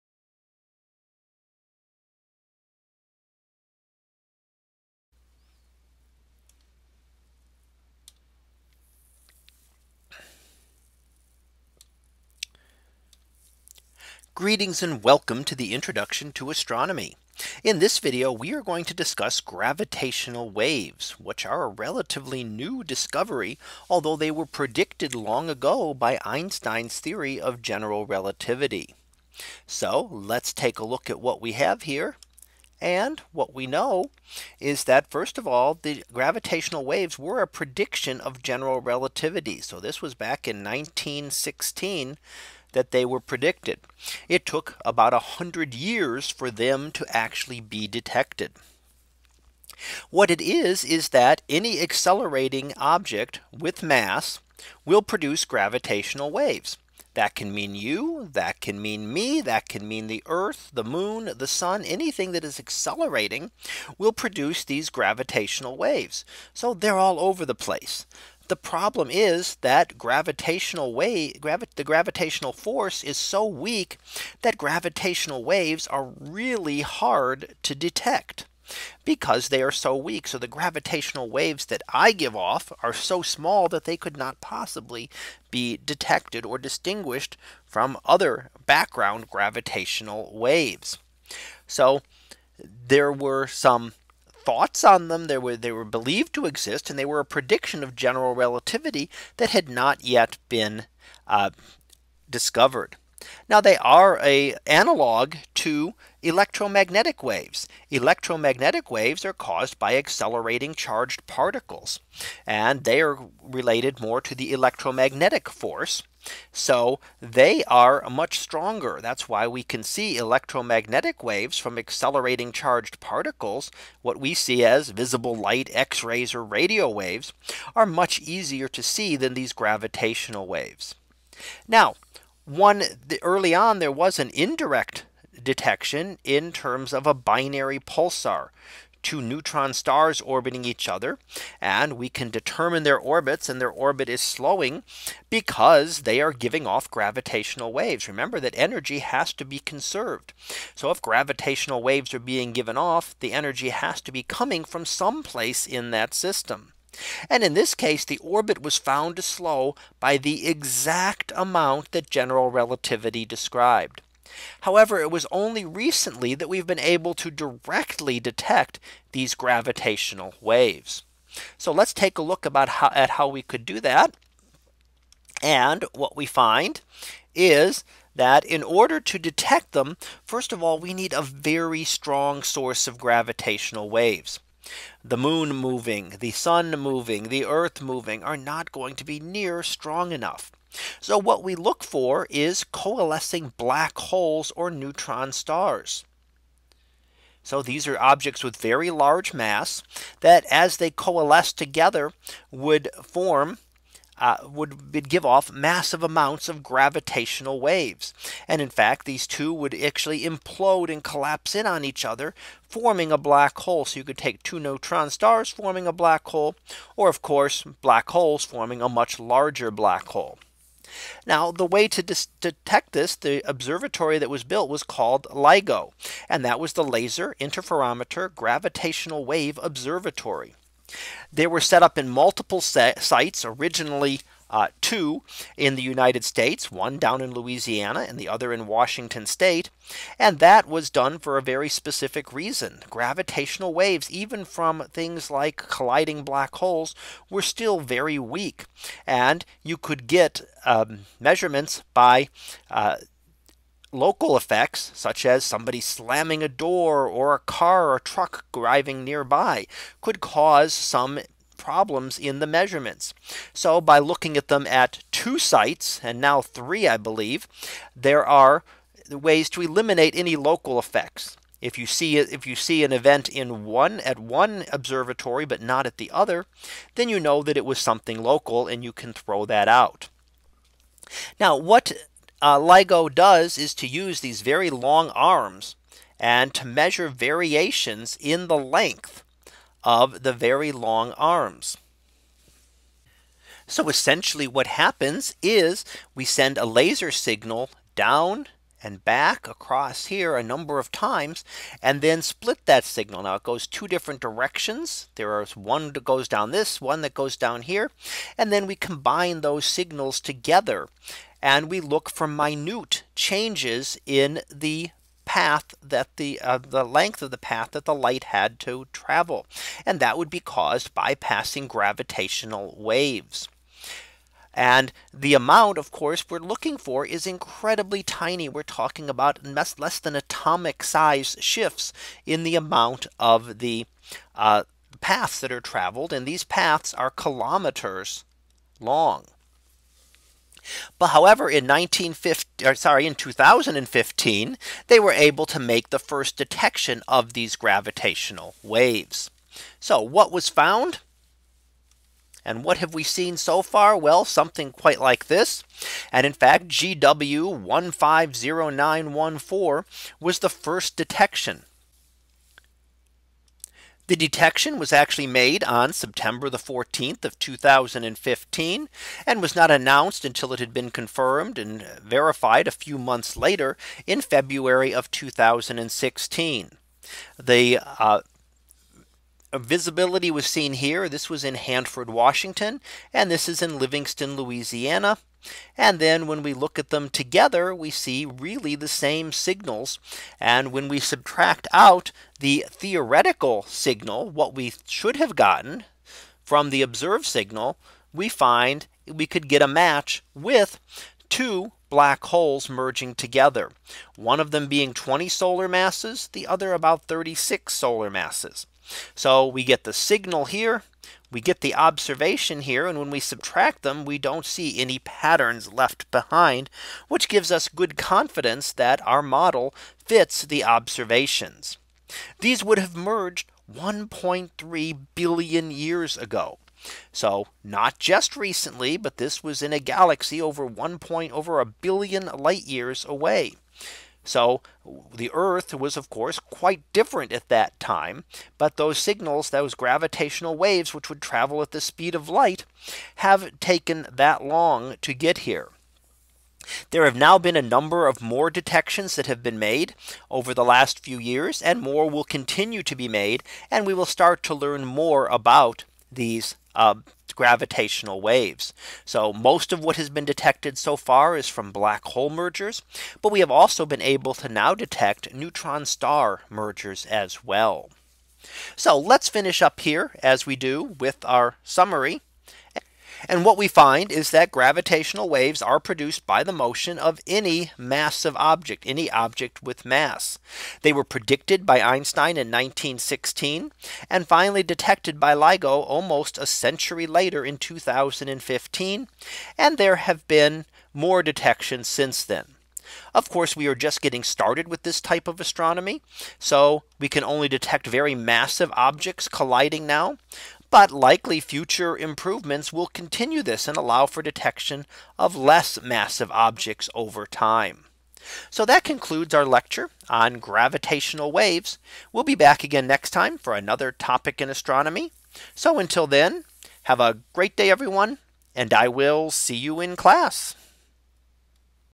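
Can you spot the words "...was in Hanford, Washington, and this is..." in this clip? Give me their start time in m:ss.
6:21.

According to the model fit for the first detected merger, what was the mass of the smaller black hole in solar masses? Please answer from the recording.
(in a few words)
20.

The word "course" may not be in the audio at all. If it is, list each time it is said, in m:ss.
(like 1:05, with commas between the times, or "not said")
3:37, 5:25, 7:16, 8:13.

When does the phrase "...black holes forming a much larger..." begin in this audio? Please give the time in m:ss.
3:37.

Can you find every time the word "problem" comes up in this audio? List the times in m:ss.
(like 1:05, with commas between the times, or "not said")
1:08, 4:21.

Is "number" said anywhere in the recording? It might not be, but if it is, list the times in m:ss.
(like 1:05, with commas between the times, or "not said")
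5:00, 7:27.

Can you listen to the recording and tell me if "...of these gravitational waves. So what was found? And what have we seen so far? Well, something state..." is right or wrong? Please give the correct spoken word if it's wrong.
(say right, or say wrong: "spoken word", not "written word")
wrong: "quite", not "state".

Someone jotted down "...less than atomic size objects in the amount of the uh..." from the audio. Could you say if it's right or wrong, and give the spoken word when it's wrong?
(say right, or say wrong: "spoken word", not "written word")
wrong: "shifts", not "objects".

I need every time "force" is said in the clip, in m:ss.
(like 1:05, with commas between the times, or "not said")
1:12, 1:55.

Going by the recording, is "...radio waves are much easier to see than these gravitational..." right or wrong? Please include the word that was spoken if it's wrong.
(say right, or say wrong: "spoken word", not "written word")
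right.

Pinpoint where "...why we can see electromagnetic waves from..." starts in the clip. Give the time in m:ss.
1:59.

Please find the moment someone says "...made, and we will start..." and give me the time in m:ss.
7:33.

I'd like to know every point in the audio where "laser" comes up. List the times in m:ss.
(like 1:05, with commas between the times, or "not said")
3:46, 4:56.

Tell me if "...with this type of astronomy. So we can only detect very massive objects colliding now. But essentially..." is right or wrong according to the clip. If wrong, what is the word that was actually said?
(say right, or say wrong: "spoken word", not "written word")
wrong: "likely", not "essentially".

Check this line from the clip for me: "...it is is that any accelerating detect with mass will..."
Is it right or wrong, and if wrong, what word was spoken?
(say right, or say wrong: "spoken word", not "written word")
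wrong: "object", not "detect".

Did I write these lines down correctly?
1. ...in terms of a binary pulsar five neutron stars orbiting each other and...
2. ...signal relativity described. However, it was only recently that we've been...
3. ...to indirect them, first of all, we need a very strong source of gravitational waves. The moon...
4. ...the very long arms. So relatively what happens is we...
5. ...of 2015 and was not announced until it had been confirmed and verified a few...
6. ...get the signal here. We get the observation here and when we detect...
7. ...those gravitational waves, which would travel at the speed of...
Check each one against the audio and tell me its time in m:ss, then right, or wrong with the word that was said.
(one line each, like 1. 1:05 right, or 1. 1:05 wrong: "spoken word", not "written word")
1. 2:16 wrong: "two", not "five"
2. 2:42 wrong: "general", not "signal"
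3. 2:59 wrong: "detect", not "indirect"
4. 4:50 wrong: "essentially", not "relatively"
5. 6:07 right
6. 6:49 wrong: "subtract", not "detect"
7. 7:19 right.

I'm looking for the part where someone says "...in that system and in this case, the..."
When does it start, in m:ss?
2:35.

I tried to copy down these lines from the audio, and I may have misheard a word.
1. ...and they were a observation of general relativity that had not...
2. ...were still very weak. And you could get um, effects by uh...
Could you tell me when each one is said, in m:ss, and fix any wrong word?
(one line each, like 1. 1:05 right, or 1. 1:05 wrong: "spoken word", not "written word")
1. 1:36 wrong: "prediction", not "observation"
2. 4:07 wrong: "measurements", not "effects".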